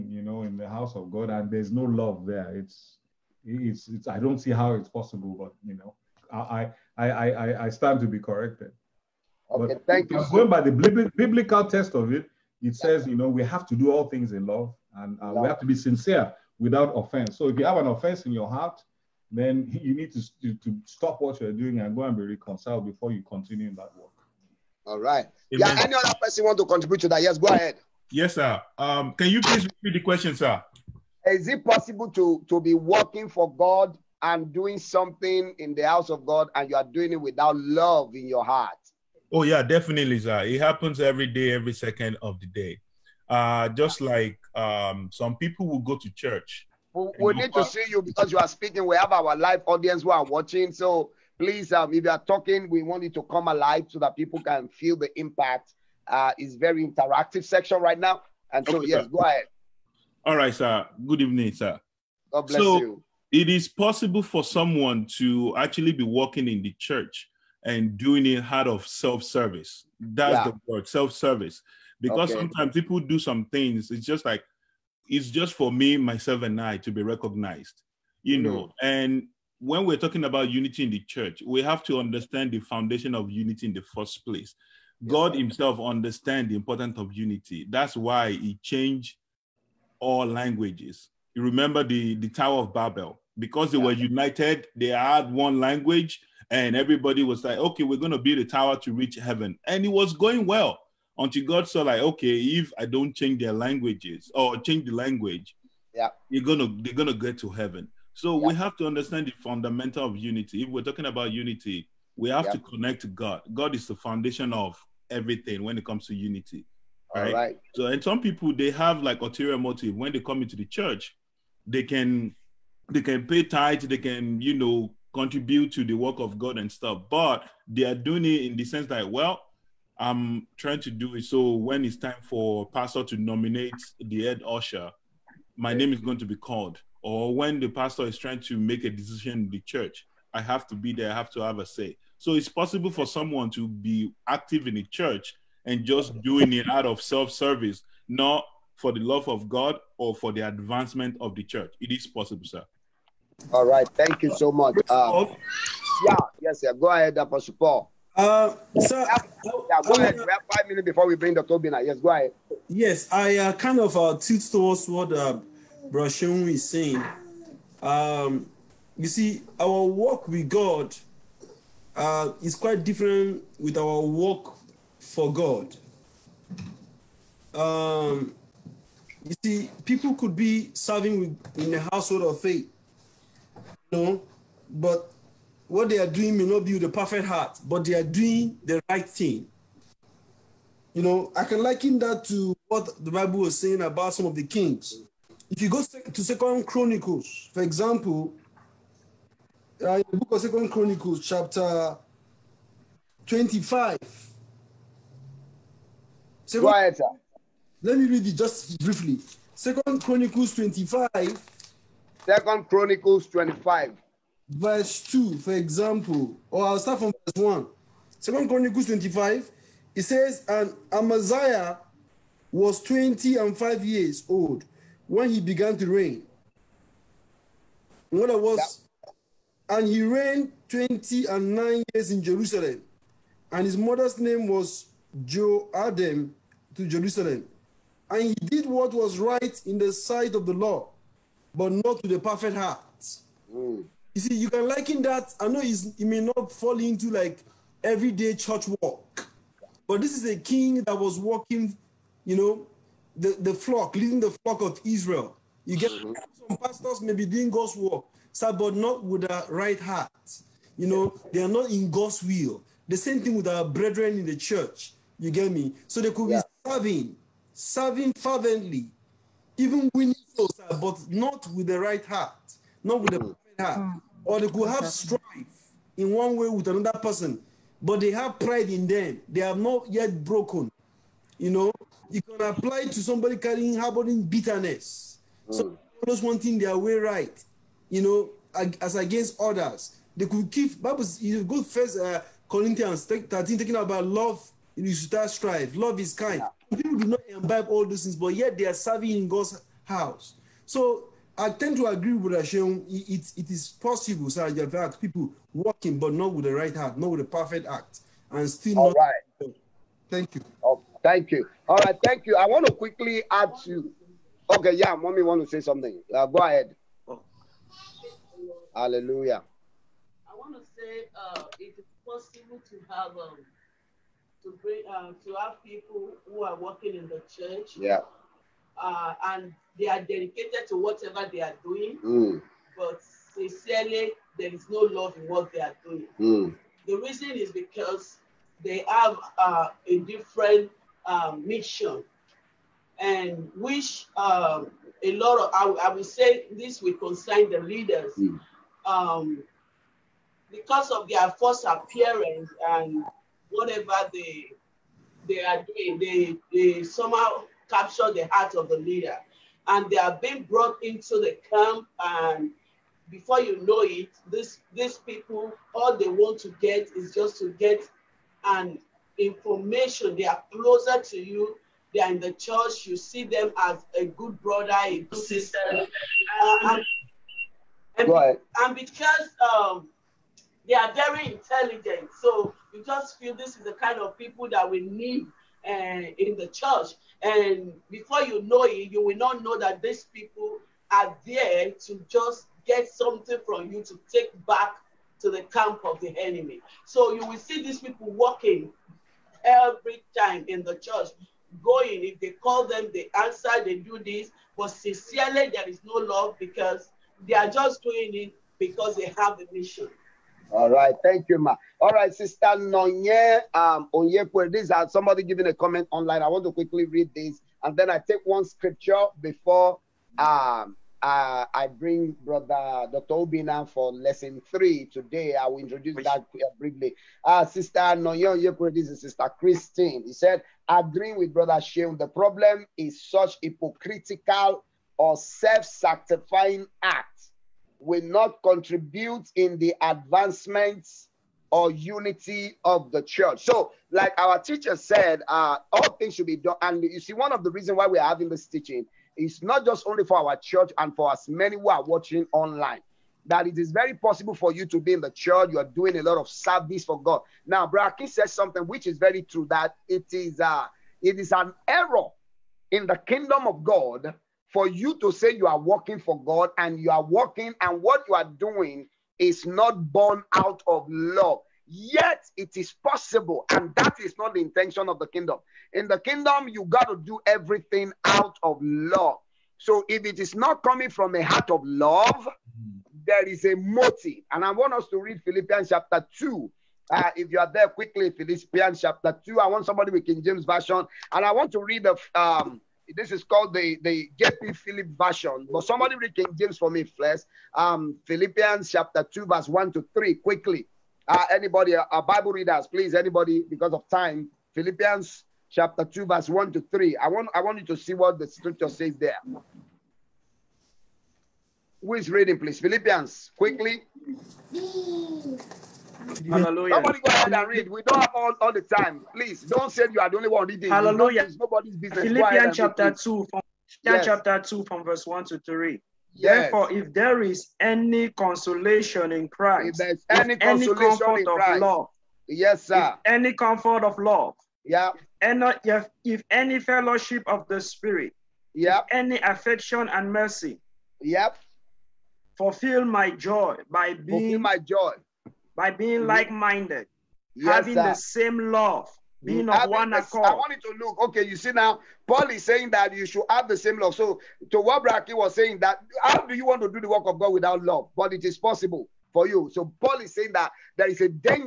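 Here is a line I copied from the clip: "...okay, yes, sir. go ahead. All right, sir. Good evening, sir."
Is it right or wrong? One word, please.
right.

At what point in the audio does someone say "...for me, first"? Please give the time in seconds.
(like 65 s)
496 s.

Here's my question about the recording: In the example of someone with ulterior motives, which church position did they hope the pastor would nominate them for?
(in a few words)
Head usher.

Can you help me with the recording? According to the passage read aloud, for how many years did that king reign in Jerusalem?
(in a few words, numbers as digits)
29.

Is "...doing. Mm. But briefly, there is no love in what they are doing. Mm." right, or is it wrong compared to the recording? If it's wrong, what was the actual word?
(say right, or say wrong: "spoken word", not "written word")
wrong: "sincerely", not "briefly".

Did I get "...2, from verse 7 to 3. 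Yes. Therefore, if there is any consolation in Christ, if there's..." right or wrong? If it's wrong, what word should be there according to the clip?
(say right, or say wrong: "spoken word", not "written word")
wrong: "1", not "7".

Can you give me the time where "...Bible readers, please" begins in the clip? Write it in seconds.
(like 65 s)
502 s.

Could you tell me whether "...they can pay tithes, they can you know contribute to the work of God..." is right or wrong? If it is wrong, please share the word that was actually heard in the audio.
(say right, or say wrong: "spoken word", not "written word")
right.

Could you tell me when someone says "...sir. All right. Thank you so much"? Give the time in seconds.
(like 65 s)
152 s.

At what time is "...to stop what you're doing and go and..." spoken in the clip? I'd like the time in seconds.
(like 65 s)
20 s.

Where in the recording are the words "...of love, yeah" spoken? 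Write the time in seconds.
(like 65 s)
533 s.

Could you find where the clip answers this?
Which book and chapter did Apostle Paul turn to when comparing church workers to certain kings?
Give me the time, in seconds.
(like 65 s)
200 s.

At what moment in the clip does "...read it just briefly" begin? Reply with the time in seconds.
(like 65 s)
208 s.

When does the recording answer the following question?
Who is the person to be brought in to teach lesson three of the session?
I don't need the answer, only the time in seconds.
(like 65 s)
422 s.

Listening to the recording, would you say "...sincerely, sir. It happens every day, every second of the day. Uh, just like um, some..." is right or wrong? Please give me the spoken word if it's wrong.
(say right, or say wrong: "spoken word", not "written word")
wrong: "definitely", not "sincerely".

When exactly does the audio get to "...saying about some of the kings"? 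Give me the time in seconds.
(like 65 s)
193 s.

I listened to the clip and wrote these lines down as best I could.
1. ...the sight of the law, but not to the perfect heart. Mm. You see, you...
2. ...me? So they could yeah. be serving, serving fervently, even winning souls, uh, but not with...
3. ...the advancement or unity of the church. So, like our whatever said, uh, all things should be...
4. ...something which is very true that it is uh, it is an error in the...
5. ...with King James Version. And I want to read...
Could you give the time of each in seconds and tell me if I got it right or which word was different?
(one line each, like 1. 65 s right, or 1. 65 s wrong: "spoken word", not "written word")
1. 239 s right
2. 265 s right
3. 439 s wrong: "teacher", not "whatever"
4. 458 s right
5. 489 s right.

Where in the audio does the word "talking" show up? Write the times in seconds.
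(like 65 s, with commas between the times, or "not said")
52 s, 79 s, 110 s, 293 s.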